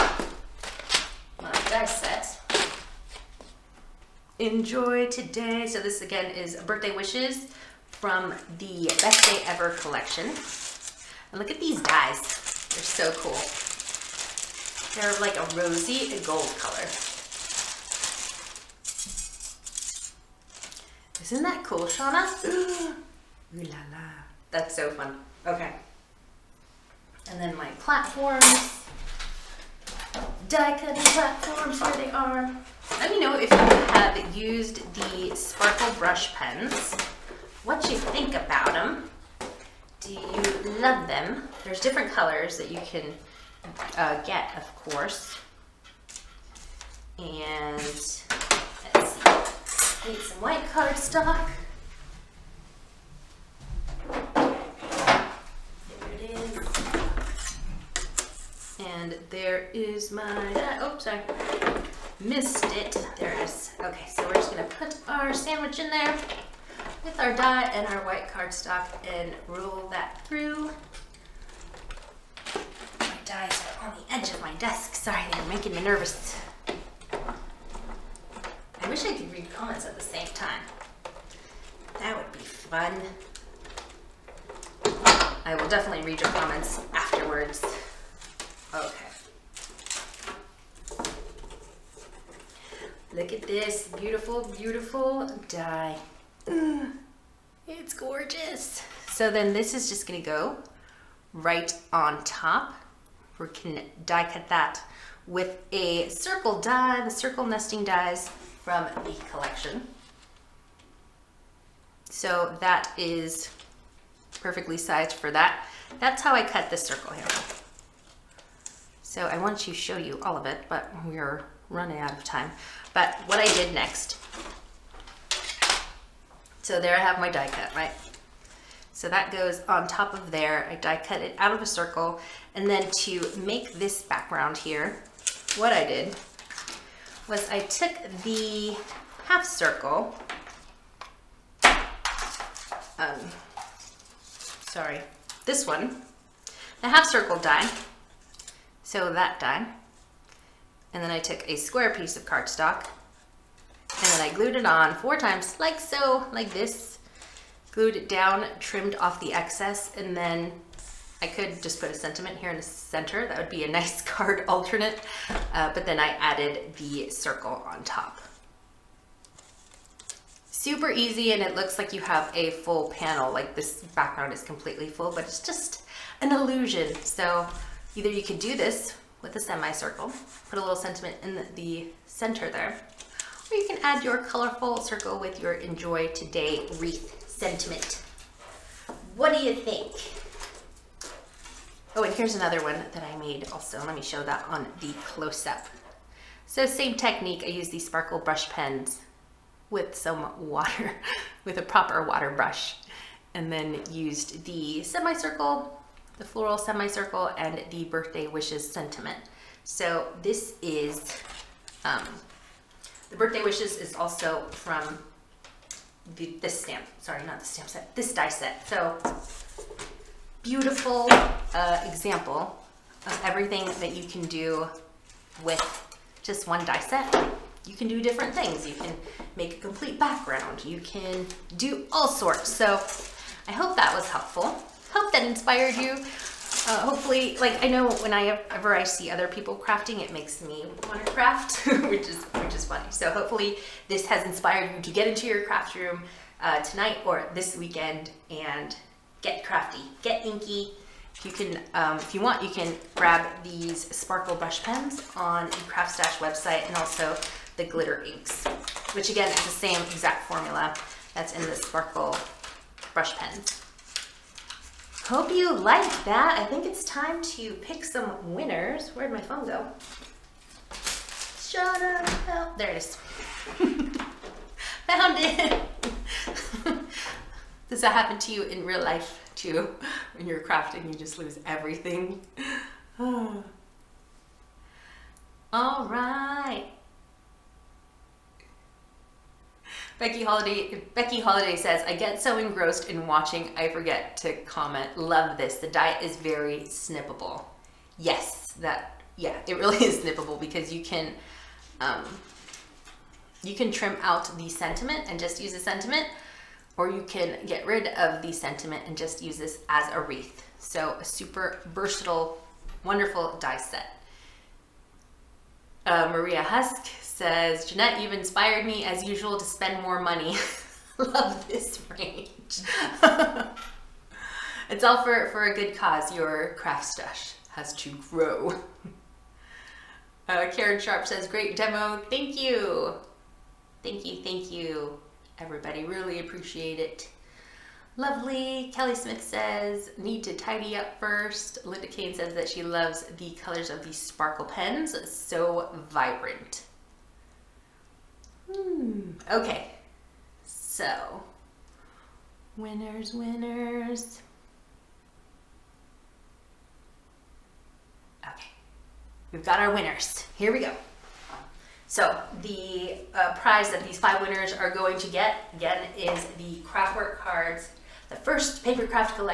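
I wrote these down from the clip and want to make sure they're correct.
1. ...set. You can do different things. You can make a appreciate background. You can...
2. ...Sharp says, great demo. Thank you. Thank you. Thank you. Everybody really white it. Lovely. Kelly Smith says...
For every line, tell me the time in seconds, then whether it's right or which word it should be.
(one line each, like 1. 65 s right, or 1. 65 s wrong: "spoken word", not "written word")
1. 226 s wrong: "complete", not "appreciate"
2. 330 s wrong: "appreciate", not "white".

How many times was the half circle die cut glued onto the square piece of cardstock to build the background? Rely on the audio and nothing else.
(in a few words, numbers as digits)
4.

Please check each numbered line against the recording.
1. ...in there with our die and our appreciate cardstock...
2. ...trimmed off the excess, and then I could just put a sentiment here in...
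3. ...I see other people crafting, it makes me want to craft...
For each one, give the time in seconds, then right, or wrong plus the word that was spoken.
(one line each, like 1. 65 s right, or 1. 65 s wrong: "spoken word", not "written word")
1. 65 s wrong: "white", not "appreciate"
2. 158 s right
3. 238 s right.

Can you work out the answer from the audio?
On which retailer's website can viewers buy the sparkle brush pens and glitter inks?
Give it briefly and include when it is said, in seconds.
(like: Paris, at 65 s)
CraftStash, at 255 s.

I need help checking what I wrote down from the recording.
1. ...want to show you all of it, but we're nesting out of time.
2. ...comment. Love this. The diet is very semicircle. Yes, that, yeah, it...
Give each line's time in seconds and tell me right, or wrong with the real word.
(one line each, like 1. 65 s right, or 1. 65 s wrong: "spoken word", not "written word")
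1. 119 s wrong: "running", not "nesting"
2. 294 s wrong: "snippable", not "semicircle".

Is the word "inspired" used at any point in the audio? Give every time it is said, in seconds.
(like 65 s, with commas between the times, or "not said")
235 s, 244 s, 318 s.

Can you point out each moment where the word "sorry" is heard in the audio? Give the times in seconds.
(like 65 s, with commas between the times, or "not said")
61 s, 74 s, 144 s, 216 s.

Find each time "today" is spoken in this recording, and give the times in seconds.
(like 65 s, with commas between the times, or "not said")
5 s, 186 s.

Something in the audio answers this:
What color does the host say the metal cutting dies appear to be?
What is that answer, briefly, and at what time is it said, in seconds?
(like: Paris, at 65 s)
rosy gold, at 15 s.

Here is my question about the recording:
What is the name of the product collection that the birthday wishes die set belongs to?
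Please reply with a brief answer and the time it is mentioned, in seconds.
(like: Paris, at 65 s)
Best Day Ever, at 9 s.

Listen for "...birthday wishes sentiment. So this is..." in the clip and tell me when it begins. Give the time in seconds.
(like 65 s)
207 s.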